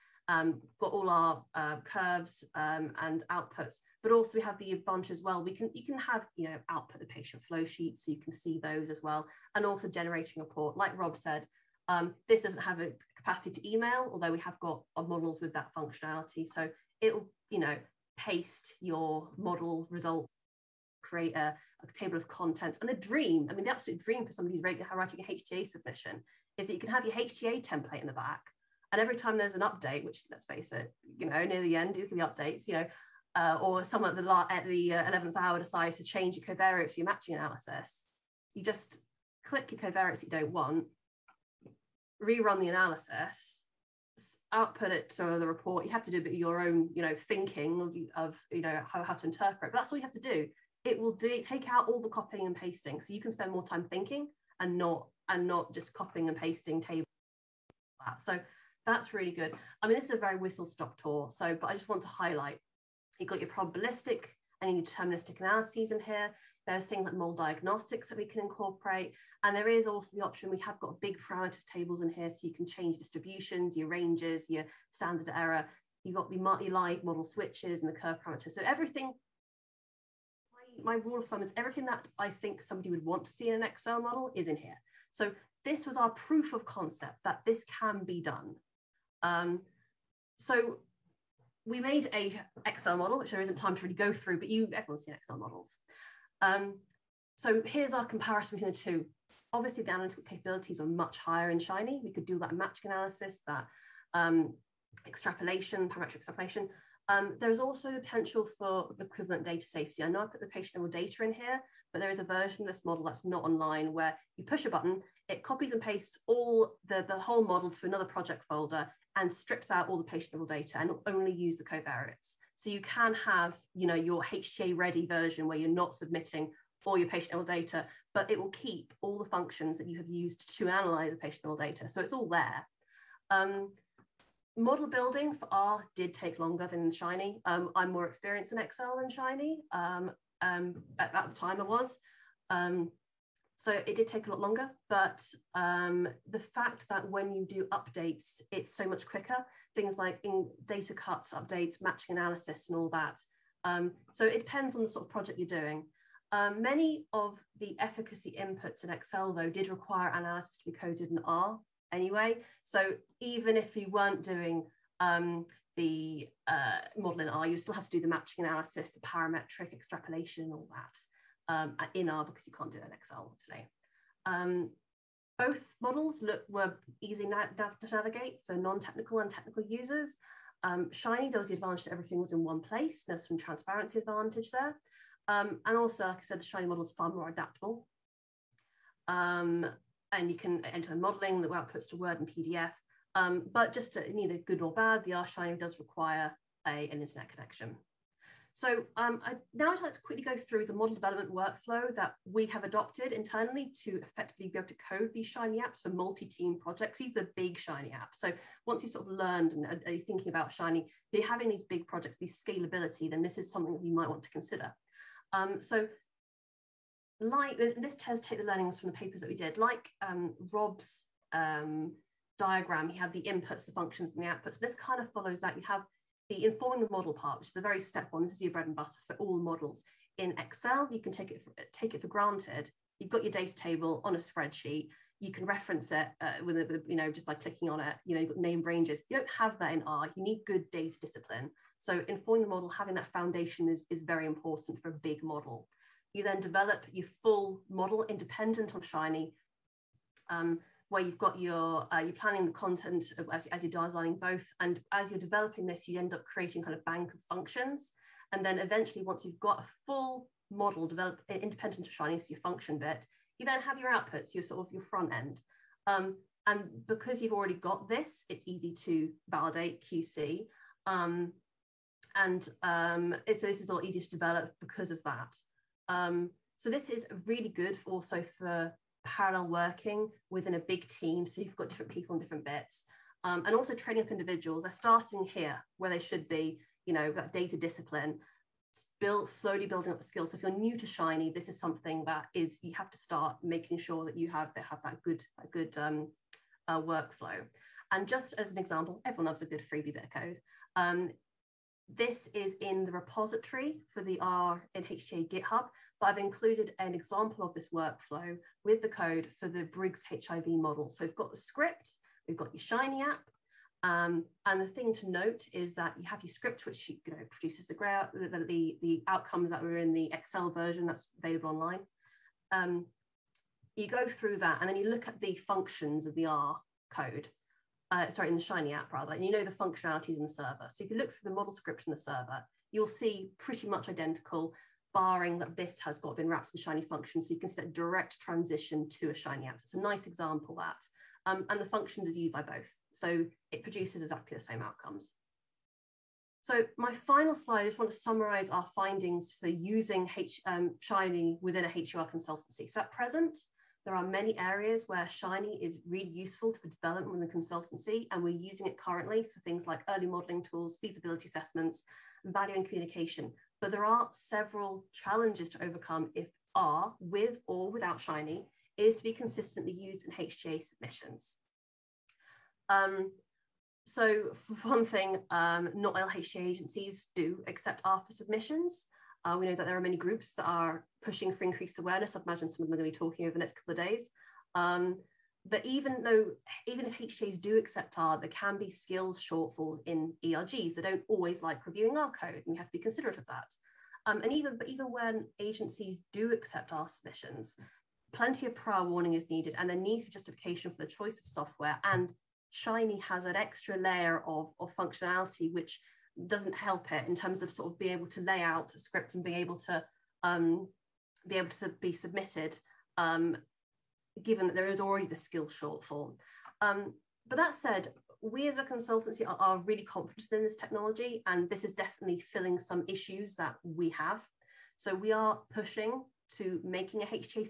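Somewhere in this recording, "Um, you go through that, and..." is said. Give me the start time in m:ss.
5:22.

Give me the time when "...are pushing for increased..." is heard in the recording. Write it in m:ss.
6:20.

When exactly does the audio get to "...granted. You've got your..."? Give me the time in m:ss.
3:52.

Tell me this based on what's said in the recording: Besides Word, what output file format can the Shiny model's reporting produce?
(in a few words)
PDF.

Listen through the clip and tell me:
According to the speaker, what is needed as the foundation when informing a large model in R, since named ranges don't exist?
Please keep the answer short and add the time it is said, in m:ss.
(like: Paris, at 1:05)
Good data discipline, at 4:00.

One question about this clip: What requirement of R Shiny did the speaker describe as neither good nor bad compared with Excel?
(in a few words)
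An internet connection.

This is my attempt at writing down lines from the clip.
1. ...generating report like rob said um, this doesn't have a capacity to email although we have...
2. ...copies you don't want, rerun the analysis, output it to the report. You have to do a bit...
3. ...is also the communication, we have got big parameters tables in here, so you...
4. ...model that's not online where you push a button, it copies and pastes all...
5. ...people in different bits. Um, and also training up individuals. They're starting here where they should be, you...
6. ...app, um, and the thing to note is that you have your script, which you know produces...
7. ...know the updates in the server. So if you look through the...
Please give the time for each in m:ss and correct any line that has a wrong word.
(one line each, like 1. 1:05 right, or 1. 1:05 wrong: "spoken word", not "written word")
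1. 0:09 right
2. 0:39 wrong: "covariates", not "copies"
3. 1:09 wrong: "option", not "communication"
4. 1:52 right
5. 4:41 right
6. 5:13 right
7. 5:29 wrong: "functionalities", not "updates".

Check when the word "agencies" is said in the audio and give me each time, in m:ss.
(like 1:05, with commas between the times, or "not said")
6:16, 6:35.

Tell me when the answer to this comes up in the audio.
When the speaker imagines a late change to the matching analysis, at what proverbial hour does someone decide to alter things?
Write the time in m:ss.
0:35.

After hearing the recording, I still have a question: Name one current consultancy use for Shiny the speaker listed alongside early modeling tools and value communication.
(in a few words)
Feasibility assessments.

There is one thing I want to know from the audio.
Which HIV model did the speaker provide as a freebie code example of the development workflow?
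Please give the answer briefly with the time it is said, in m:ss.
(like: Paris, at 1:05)
Briggs HIV model, at 5:09.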